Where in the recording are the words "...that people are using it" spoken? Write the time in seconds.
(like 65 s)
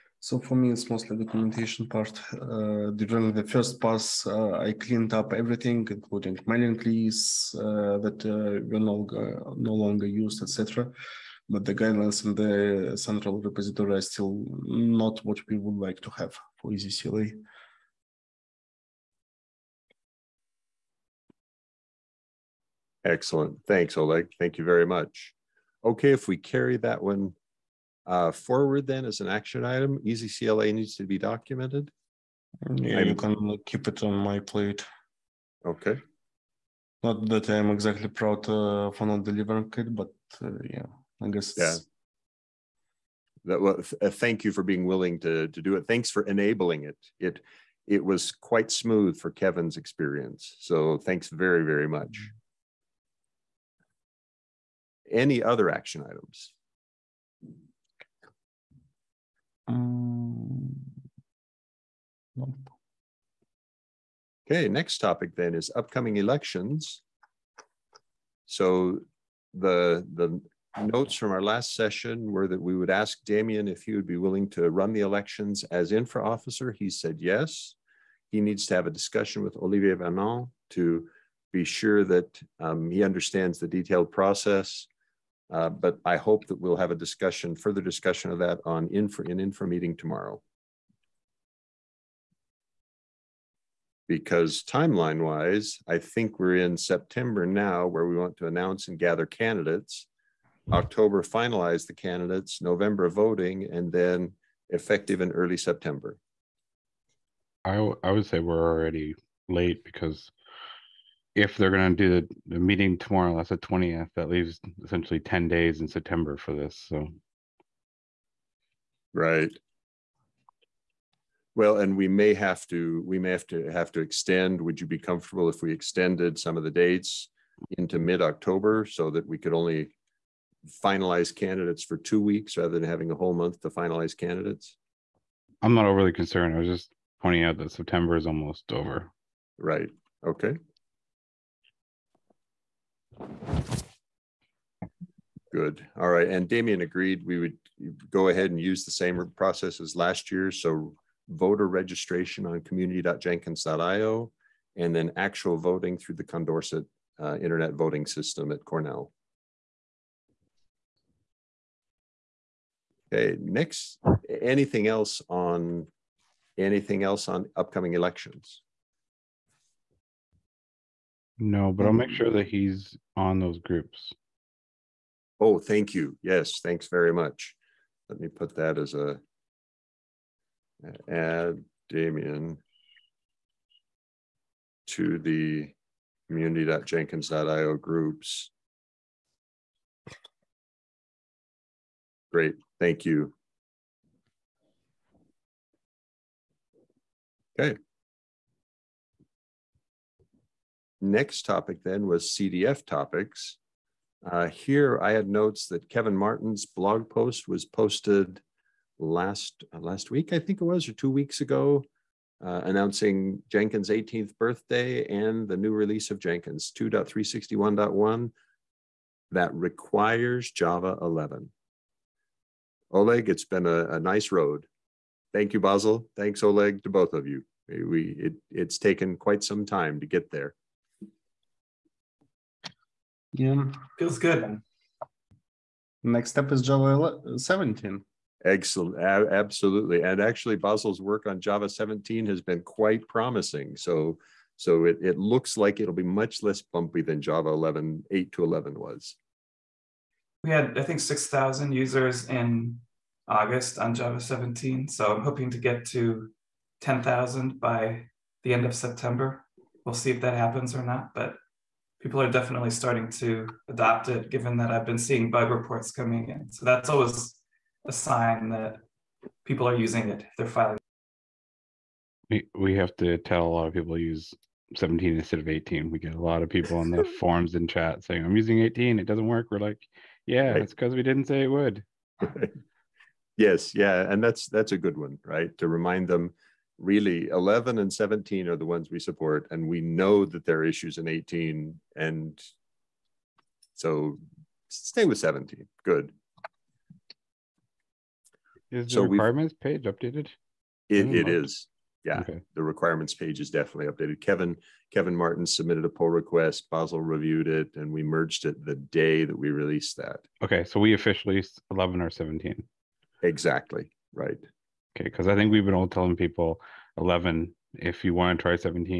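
268 s.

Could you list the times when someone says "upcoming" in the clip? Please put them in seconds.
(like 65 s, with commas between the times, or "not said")
65 s, 167 s.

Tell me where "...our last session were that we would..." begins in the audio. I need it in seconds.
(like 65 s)
71 s.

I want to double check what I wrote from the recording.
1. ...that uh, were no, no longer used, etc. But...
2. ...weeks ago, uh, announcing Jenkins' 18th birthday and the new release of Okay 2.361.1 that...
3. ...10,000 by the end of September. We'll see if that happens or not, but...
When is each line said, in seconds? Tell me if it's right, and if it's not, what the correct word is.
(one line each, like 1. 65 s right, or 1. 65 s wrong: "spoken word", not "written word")
1. 8 s right
2. 211 s wrong: "Jenkins", not "Okay"
3. 256 s right.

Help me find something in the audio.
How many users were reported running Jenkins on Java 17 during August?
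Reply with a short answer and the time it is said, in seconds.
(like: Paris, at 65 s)
6,000, at 250 s.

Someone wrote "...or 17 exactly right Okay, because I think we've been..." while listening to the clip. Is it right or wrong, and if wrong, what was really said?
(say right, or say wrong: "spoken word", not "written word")
right.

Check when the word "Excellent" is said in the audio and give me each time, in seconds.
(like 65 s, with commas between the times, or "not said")
23 s, 238 s.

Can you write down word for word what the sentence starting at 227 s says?
We it, it's taken quite some time to get there.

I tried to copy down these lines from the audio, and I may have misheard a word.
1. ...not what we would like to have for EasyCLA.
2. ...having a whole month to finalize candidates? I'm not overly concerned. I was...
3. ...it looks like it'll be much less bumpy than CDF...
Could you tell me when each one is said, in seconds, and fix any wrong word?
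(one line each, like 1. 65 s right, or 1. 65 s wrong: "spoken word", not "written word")
1. 14 s right
2. 132 s right
3. 245 s wrong: "Java", not "CDF".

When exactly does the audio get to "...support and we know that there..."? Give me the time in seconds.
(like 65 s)
288 s.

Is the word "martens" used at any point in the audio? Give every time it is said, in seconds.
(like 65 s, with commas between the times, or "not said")
206 s, 305 s.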